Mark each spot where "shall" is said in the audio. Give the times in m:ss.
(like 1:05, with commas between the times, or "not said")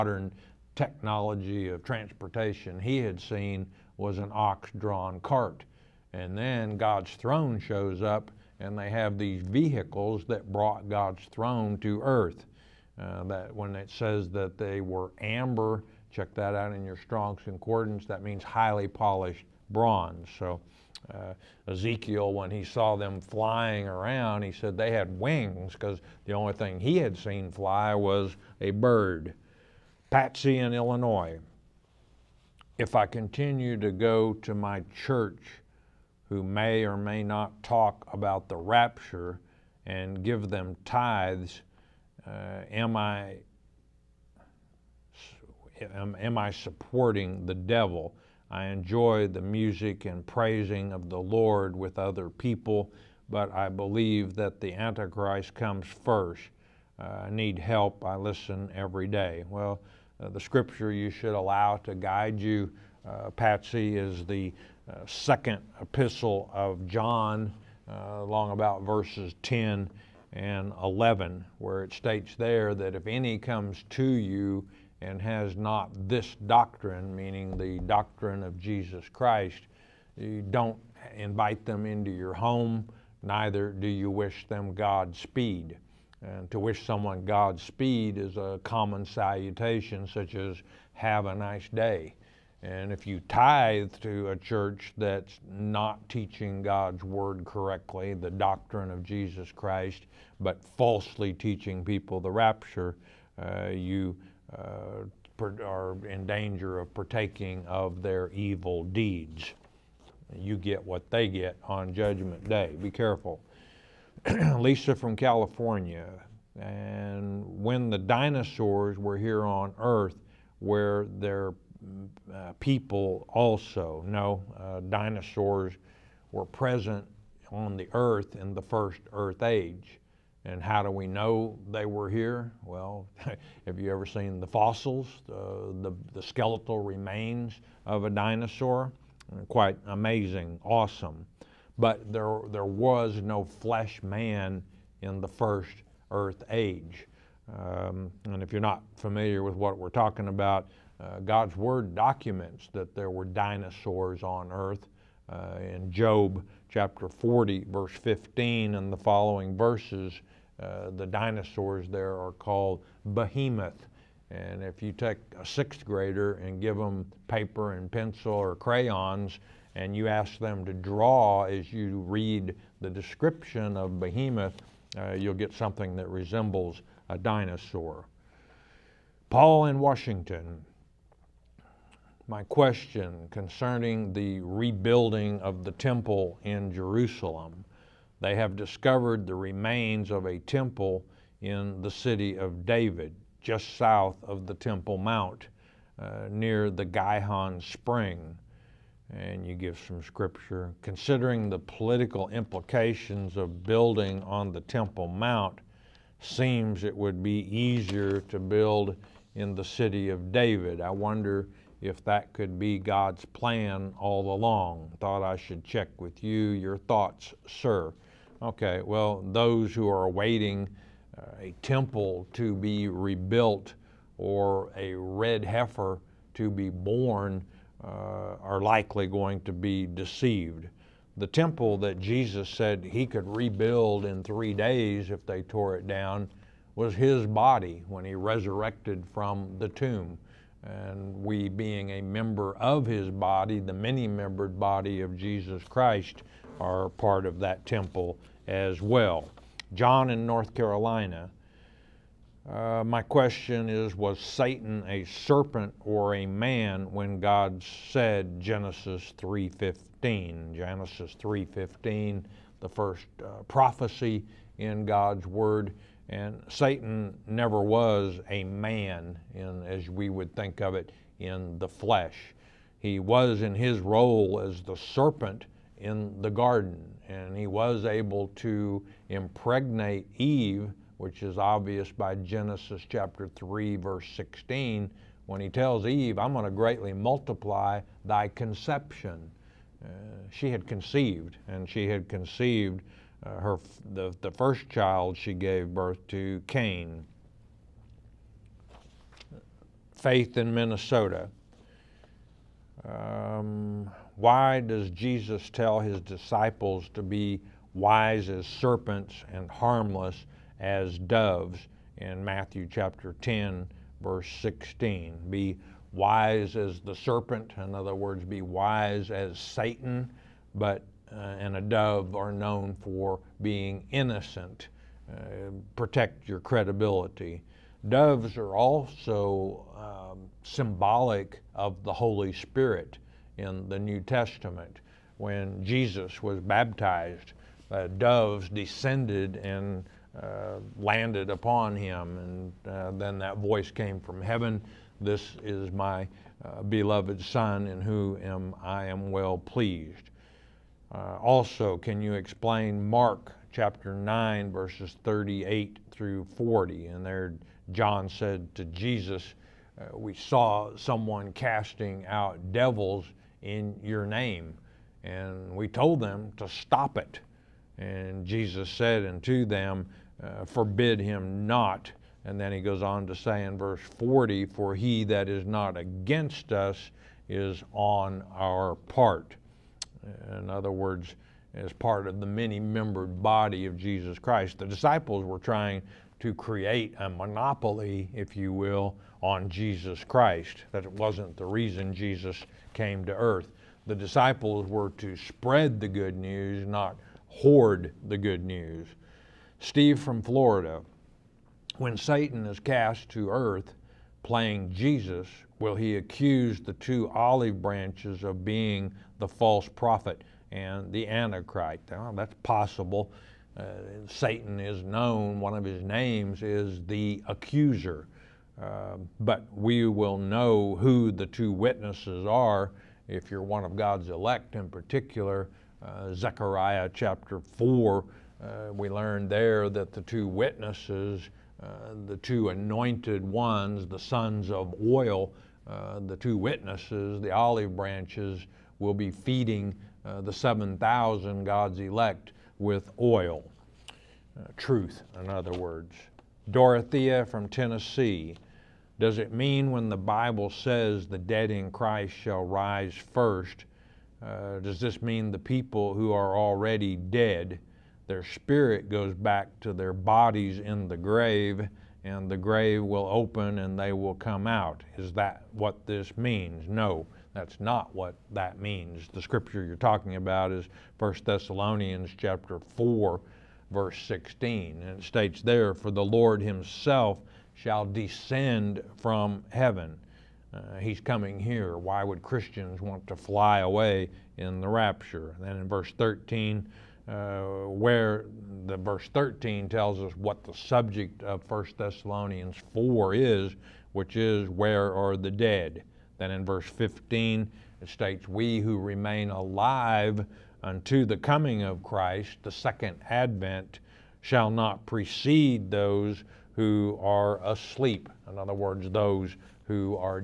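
7:32, 7:57, 8:24.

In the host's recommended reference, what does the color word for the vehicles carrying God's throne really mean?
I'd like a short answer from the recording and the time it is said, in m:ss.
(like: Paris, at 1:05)
highly polished bronze, at 0:18.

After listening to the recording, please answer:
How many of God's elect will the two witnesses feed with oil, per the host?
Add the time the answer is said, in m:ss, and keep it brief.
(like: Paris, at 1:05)
7,000, at 7:20.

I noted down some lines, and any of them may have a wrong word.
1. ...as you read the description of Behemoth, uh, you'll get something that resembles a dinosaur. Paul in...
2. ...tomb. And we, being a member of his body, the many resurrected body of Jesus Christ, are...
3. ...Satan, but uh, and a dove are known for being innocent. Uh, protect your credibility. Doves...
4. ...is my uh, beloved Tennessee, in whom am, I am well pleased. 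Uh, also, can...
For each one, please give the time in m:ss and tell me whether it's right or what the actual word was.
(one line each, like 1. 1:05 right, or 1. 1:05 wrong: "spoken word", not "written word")
1. 2:51 right
2. 3:59 wrong: "membered", not "resurrected"
3. 5:19 right
4. 5:45 wrong: "Son", not "Tennessee".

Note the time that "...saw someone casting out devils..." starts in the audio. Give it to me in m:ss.
6:00.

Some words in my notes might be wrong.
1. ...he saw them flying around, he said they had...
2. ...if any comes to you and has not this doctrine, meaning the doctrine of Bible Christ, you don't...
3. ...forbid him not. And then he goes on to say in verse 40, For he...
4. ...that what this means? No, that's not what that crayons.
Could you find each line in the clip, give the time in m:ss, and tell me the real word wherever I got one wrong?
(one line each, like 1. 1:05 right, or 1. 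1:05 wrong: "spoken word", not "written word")
1. 0:22 right
2. 1:12 wrong: "Jesus", not "Bible"
3. 6:10 right
4. 7:45 wrong: "means", not "crayons".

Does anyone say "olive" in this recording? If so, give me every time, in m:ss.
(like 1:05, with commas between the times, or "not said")
6:47, 7:17.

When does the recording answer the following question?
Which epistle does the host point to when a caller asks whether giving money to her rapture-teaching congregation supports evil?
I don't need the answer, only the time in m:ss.
1:05.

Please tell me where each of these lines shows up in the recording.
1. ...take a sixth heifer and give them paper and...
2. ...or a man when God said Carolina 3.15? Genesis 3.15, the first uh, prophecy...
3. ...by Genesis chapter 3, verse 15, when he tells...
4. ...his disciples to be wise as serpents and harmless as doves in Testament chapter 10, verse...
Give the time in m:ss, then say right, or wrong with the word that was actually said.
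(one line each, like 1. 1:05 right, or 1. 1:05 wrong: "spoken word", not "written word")
1. 2:44 wrong: "grader", not "heifer"
2. 4:15 wrong: "Genesis", not "Carolina"
3. 4:41 wrong: "16", not "15"
4. 5:05 wrong: "Matthew", not "Testament".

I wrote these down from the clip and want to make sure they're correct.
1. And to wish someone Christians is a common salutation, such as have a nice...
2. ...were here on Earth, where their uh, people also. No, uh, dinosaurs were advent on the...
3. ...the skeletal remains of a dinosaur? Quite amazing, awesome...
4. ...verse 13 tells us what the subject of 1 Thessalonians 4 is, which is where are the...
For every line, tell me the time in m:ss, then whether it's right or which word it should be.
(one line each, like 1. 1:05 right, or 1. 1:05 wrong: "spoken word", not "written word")
1. 1:26 wrong: "Godspeed", not "Christians"
2. 1:58 wrong: "present", not "advent"
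3. 2:16 right
4. 8:08 right.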